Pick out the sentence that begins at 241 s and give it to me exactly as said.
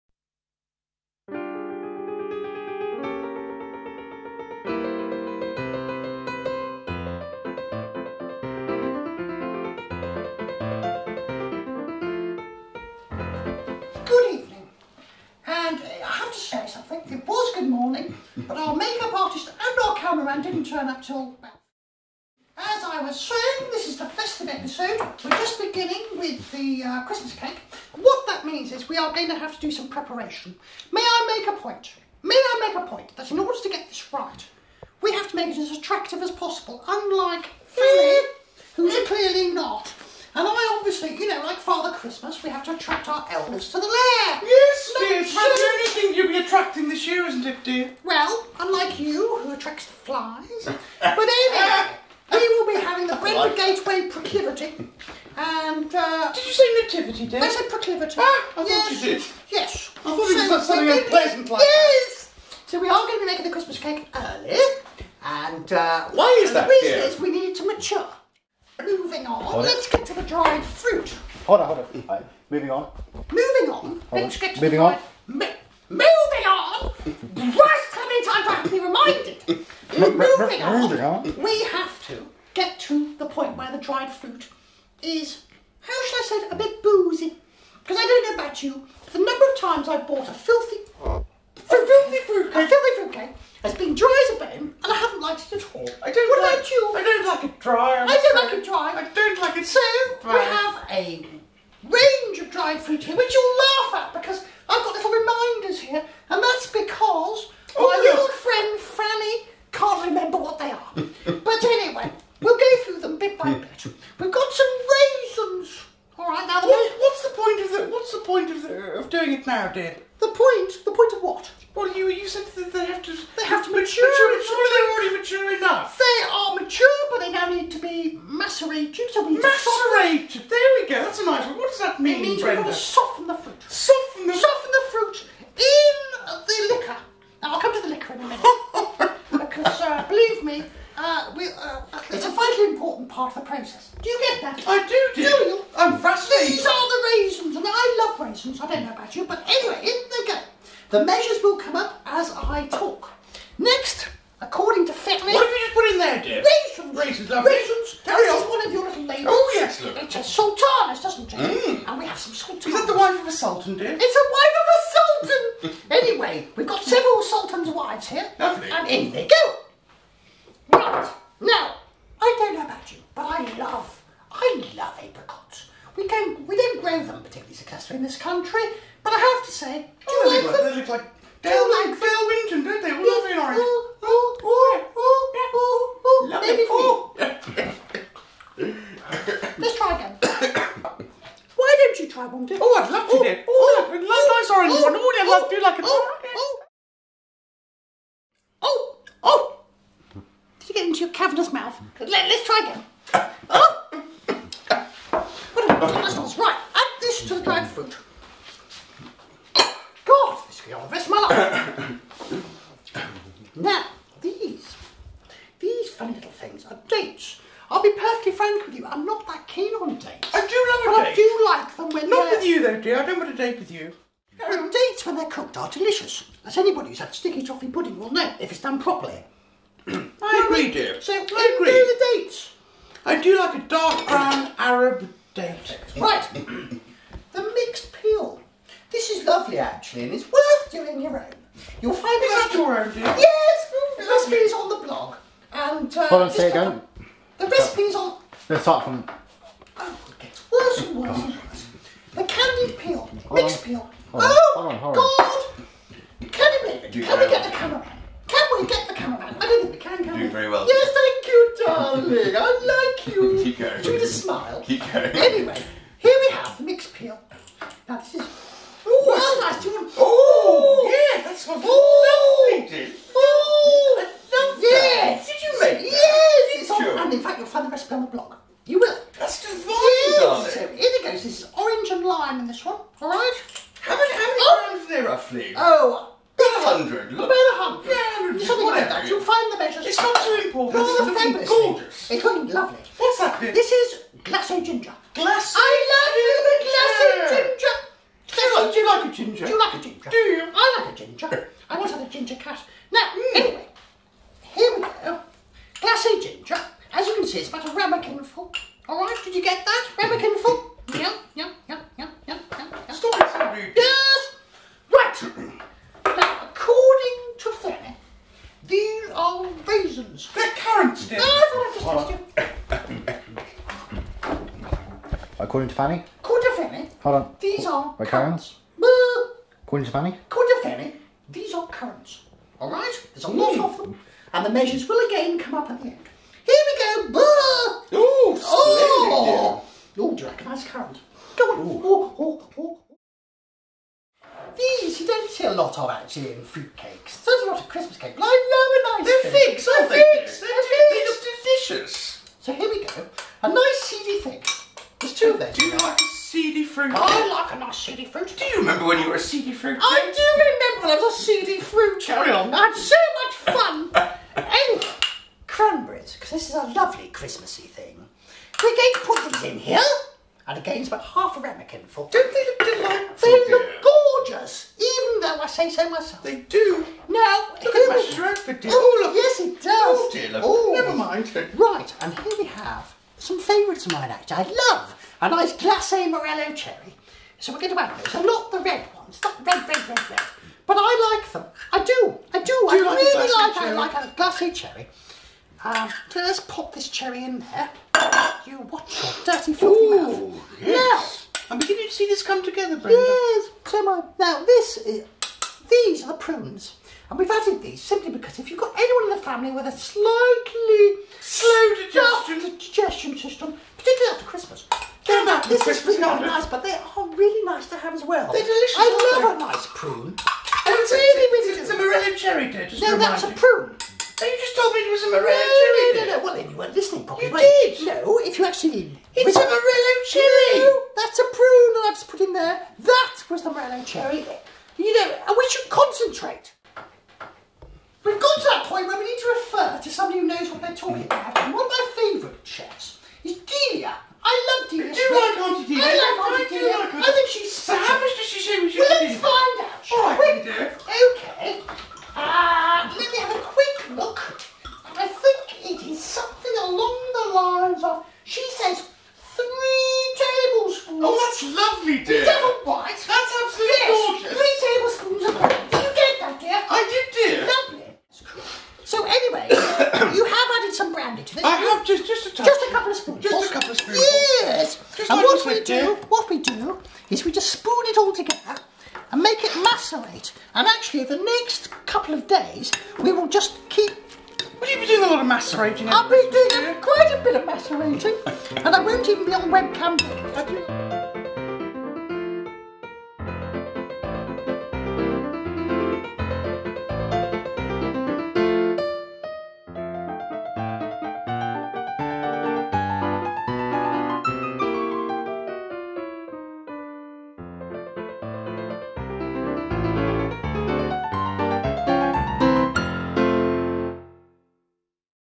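You'll find is that your own, dear?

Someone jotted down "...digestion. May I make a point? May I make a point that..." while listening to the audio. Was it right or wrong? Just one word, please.
wrong.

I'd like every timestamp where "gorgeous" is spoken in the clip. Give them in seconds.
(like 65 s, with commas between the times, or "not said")
291 s, 374 s.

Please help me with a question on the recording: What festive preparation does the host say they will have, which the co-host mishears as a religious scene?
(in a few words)
Brenda Gateway proclivity.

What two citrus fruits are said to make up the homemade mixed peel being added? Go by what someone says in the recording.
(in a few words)
orange and lime.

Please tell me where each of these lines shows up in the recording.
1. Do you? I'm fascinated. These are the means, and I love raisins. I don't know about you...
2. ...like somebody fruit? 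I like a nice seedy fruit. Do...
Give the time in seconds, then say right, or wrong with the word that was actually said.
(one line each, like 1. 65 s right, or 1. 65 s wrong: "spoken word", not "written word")
1. 145 s wrong: "raisins", not "means"
2. 355 s wrong: "seedy", not "somebody".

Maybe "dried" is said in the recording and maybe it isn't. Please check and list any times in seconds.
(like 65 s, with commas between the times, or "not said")
70 s, 83 s, 102 s, 207 s.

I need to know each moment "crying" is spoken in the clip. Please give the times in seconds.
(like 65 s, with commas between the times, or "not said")
not said.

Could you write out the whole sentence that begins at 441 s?
about, one of my favourite chefs is Delia.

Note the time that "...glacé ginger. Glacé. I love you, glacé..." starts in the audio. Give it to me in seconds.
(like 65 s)
294 s.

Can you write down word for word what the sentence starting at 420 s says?
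And it's really, really it's, it's a morello cherry there.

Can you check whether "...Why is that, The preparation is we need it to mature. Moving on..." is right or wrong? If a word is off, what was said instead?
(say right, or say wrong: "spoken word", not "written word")
wrong: "reason", not "preparation".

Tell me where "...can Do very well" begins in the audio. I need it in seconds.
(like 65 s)
260 s.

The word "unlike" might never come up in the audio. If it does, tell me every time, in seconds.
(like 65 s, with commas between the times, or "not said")
36 s, 48 s.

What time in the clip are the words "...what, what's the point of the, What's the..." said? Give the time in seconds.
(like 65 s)
116 s.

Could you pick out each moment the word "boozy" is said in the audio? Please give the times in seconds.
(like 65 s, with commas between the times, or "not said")
86 s.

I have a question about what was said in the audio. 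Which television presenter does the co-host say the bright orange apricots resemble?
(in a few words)
Dale Winton.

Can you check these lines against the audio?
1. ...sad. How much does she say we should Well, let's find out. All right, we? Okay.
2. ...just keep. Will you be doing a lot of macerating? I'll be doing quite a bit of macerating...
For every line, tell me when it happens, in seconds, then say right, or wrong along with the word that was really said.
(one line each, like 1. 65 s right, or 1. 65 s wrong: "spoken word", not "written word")
1. 447 s right
2. 483 s right.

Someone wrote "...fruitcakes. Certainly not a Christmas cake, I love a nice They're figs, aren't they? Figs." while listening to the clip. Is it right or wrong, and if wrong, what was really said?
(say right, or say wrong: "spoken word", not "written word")
right.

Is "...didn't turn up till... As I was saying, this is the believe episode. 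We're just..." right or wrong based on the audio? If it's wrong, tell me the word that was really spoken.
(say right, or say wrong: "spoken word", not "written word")
wrong: "festive", not "believe".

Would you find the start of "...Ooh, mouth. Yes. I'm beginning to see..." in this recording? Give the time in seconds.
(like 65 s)
399 s.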